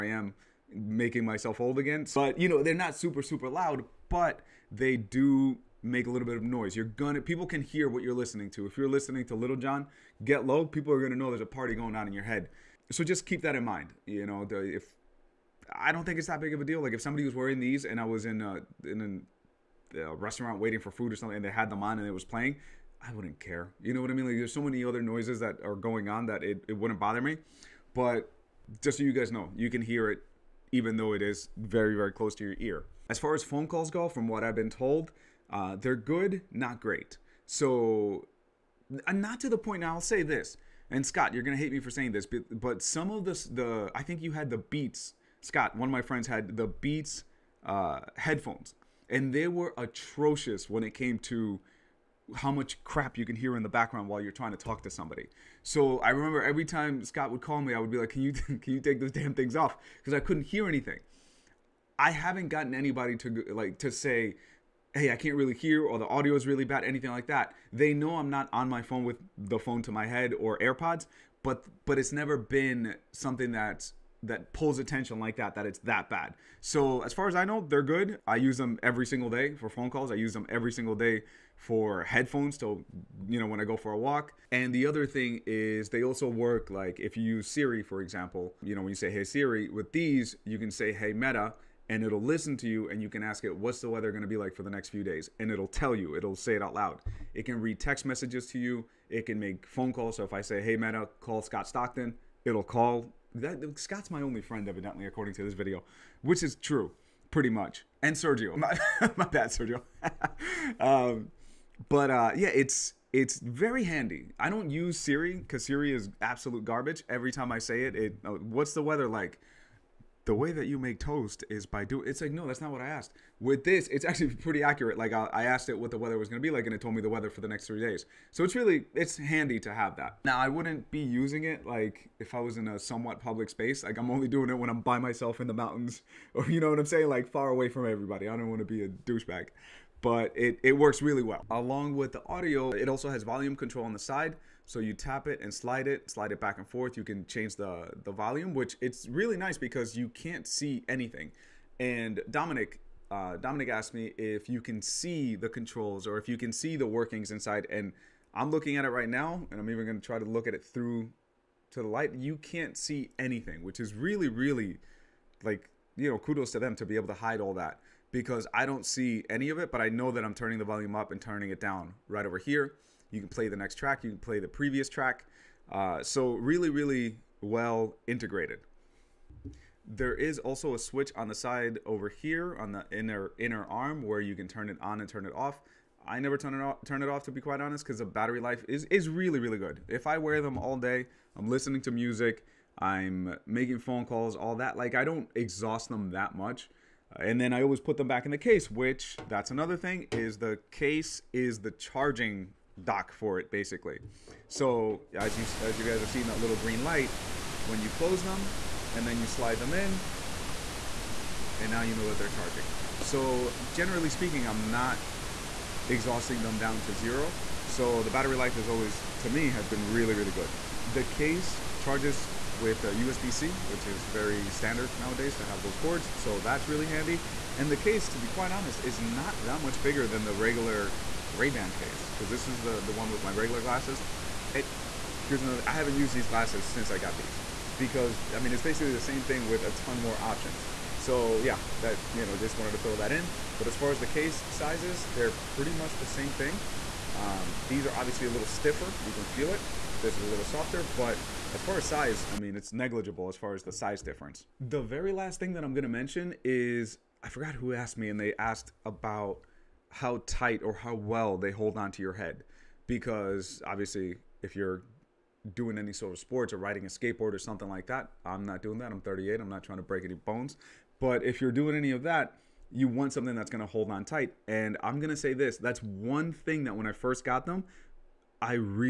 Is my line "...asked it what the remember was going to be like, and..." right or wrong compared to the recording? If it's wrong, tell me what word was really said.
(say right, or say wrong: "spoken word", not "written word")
wrong: "weather", not "remember".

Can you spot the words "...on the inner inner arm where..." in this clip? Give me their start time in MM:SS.
03:02.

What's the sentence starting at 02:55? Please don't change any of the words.
Uh, so, really, really well integrated.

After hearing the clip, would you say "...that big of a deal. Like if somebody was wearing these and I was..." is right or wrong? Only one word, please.
right.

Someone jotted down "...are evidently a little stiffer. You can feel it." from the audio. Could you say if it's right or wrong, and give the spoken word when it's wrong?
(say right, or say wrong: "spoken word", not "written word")
wrong: "obviously", not "evidently".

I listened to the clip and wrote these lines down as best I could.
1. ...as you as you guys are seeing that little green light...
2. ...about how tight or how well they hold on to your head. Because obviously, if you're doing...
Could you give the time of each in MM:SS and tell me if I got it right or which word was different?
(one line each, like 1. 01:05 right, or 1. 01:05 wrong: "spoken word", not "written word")
1. 03:25 right
2. 04:18 right.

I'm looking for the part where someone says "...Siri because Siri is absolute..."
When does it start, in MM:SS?
01:54.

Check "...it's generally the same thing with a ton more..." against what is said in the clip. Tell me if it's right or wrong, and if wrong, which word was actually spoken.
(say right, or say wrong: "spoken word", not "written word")
wrong: "basically", not "generally".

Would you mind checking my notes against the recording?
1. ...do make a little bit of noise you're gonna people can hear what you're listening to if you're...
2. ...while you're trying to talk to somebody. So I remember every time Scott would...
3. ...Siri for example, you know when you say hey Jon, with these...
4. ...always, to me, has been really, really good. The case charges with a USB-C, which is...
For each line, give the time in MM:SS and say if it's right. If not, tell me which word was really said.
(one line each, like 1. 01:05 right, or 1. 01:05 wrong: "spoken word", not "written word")
1. 00:04 right
2. 00:54 right
3. 01:27 wrong: "Siri", not "Jon"
4. 03:38 right.